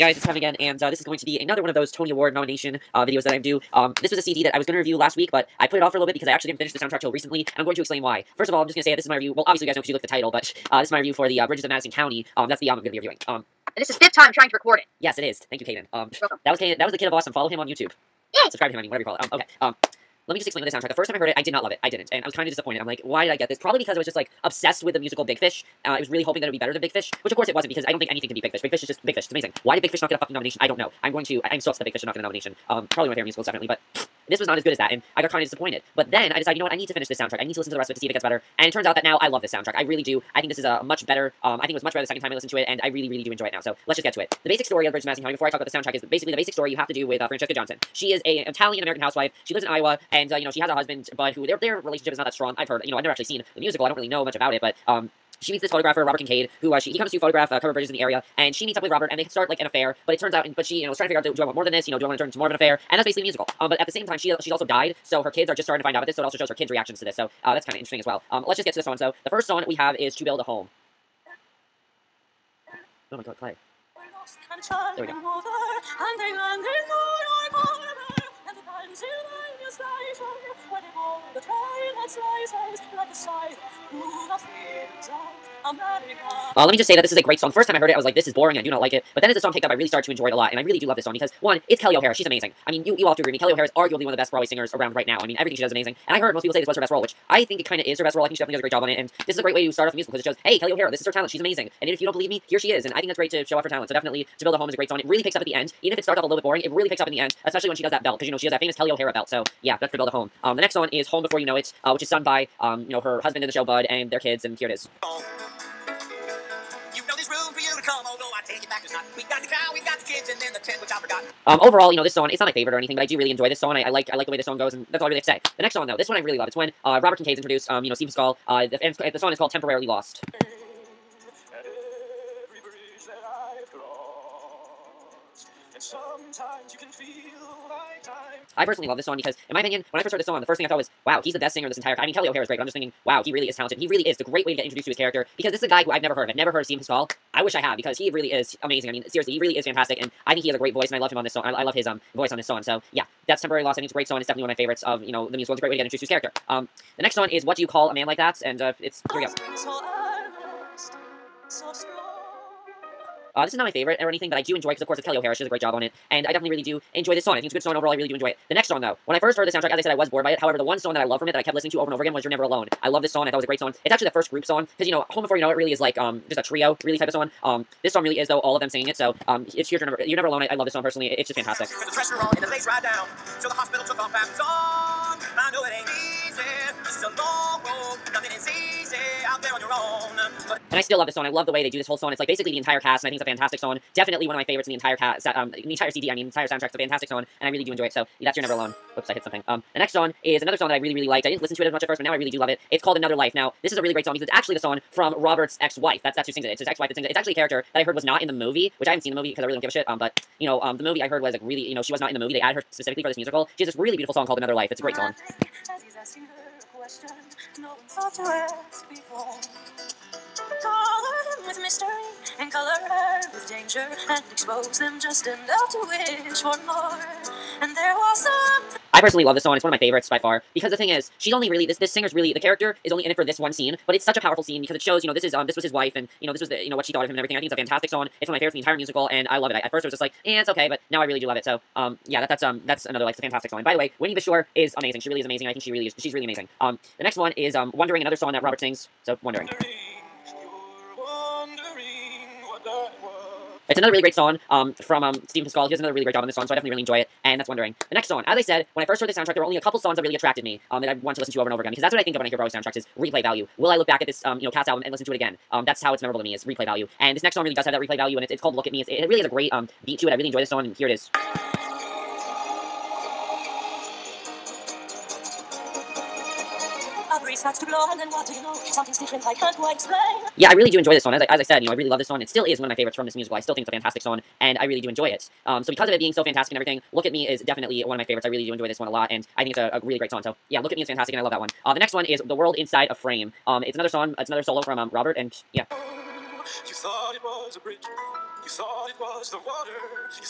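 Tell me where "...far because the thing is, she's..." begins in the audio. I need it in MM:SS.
03:50.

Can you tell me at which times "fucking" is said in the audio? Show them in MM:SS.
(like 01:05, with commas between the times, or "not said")
00:30.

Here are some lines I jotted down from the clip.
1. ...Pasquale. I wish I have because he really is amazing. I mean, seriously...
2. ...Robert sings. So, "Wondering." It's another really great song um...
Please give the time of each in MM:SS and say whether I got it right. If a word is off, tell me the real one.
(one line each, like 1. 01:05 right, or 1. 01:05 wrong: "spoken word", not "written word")
1. 02:26 right
2. 04:08 right.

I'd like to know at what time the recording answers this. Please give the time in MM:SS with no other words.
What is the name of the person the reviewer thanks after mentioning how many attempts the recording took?
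00:15.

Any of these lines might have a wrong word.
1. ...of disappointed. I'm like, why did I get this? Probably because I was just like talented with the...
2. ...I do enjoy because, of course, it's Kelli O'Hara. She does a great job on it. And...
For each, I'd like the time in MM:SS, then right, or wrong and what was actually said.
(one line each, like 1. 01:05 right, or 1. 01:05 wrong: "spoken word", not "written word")
1. 00:22 wrong: "obsessed", not "talented"
2. 02:44 right.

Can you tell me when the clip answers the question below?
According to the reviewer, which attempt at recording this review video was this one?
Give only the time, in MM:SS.
00:13.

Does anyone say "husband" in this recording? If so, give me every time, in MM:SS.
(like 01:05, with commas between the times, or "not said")
00:50, 01:53.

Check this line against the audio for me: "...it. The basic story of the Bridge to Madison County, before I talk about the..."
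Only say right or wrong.
right.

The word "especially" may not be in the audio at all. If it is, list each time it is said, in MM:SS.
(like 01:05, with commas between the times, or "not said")
01:47.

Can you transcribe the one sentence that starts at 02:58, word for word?
So um, it's here's your number.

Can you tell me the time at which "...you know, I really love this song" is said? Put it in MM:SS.
04:41.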